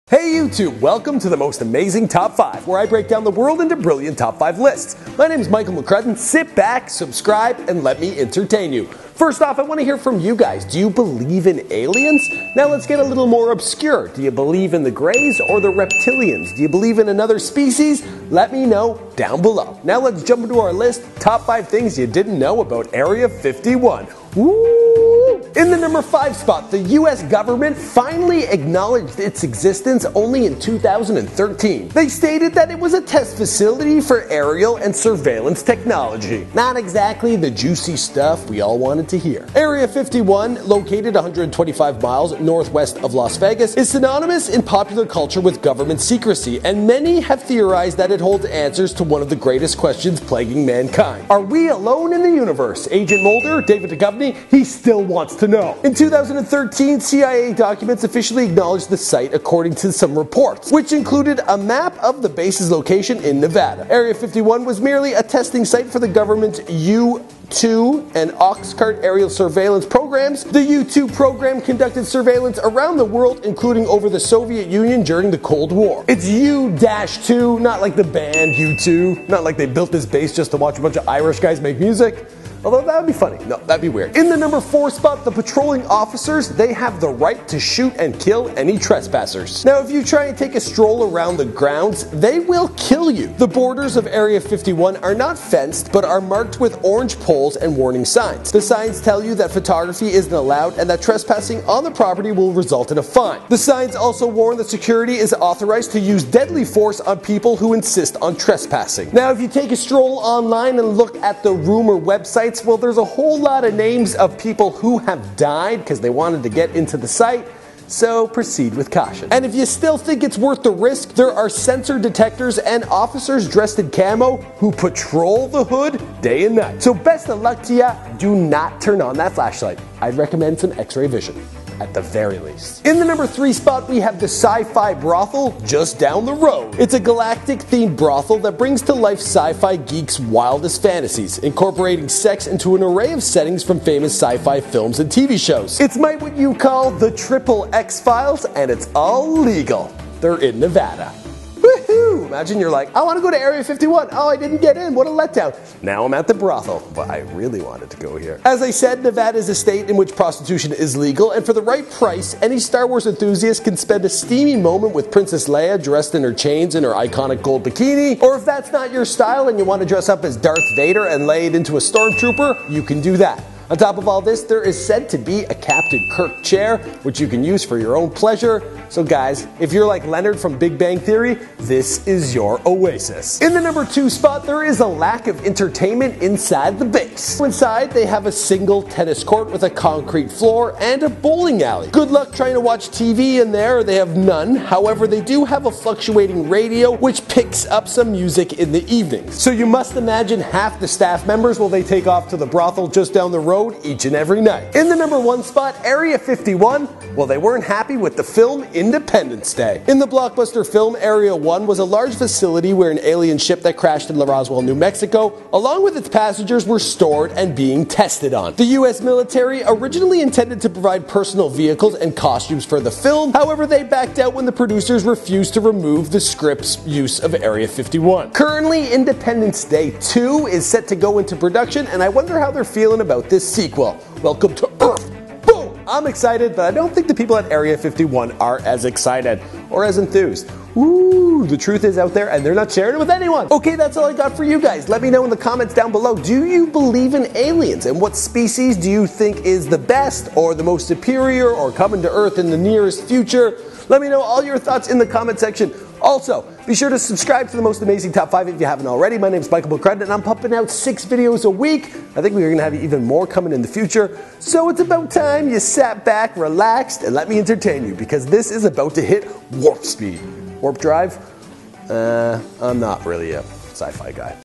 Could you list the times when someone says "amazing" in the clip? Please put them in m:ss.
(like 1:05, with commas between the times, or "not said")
0:01, 4:17.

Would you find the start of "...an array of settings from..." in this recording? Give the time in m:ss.
2:22.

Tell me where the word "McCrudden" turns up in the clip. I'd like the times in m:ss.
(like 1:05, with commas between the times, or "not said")
0:05, 4:19.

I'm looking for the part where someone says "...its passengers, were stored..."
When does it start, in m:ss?
3:35.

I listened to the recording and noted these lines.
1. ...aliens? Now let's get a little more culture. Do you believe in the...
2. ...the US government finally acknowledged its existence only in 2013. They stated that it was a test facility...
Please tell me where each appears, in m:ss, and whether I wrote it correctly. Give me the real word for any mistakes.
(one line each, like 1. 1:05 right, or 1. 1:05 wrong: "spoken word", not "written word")
1. 0:11 wrong: "obscure", not "culture"
2. 0:26 right.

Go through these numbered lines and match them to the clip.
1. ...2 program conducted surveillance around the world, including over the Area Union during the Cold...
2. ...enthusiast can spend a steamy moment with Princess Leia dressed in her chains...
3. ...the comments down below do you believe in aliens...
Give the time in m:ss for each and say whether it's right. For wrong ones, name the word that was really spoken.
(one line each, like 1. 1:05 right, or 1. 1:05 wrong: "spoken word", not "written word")
1. 1:10 wrong: "Soviet", not "Area"
2. 2:43 right
3. 4:05 right.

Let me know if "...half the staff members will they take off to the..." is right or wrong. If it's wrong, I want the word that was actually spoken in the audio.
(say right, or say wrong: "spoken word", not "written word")
right.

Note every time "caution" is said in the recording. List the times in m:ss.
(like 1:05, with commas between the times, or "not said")
1:58.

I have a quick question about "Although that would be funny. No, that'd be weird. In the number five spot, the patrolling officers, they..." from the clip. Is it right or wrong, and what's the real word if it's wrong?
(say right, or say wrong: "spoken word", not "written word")
wrong: "four", not "five".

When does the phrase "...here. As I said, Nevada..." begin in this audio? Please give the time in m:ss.
2:38.